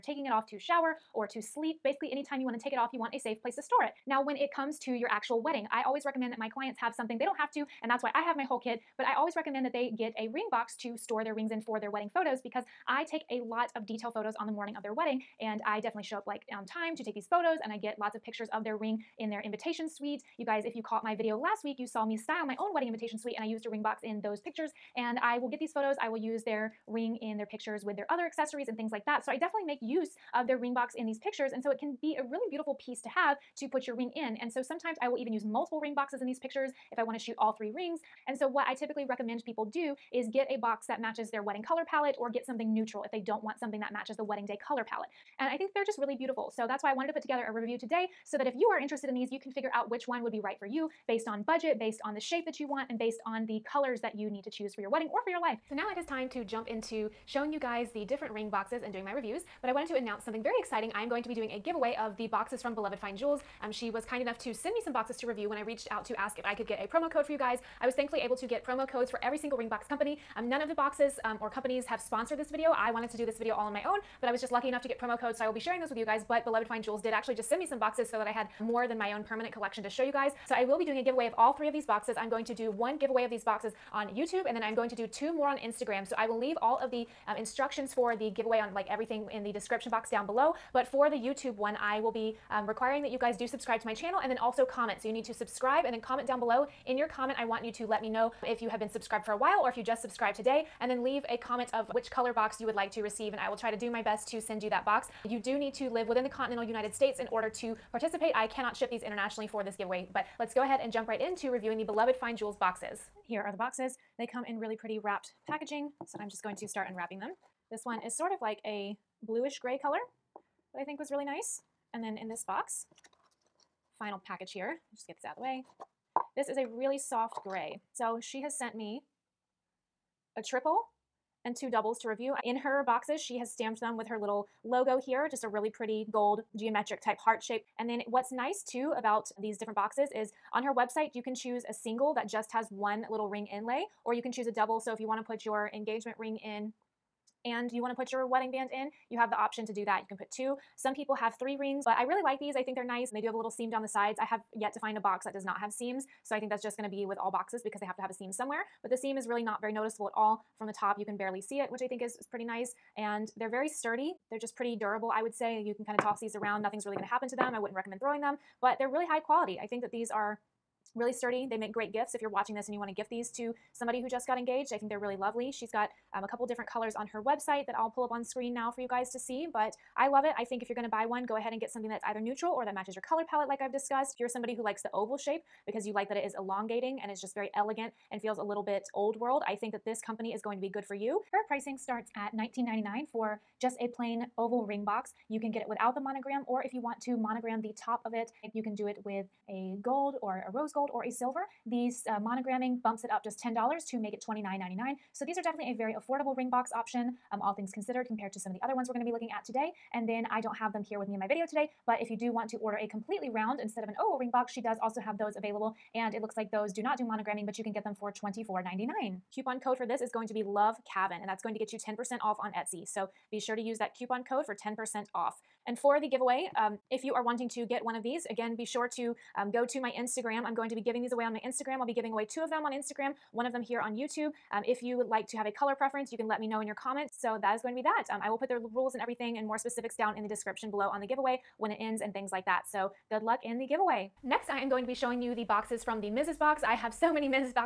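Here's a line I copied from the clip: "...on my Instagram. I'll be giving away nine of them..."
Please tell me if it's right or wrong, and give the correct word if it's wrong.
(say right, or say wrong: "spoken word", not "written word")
wrong: "two", not "nine".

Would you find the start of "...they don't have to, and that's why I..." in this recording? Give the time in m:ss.
0:07.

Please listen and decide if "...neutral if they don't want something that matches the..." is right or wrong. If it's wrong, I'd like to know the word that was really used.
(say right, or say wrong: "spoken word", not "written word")
right.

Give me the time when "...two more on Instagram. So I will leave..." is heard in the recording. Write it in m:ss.
1:25.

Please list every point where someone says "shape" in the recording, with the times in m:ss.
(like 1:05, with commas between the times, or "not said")
0:52, 2:17, 3:05.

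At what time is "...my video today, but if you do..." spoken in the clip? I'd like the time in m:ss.
3:31.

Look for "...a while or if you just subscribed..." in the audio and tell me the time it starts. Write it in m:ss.
1:39.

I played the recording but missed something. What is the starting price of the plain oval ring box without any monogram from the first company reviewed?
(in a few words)
$19.99.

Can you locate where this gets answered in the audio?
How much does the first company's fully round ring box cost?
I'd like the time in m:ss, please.
3:38.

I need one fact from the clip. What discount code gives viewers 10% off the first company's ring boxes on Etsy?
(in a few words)
LOVECAVIN.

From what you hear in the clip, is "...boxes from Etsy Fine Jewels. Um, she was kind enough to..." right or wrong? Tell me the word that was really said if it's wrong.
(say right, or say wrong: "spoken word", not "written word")
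wrong: "Beloved", not "Etsy".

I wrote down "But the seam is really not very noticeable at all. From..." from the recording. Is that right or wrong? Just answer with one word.
right.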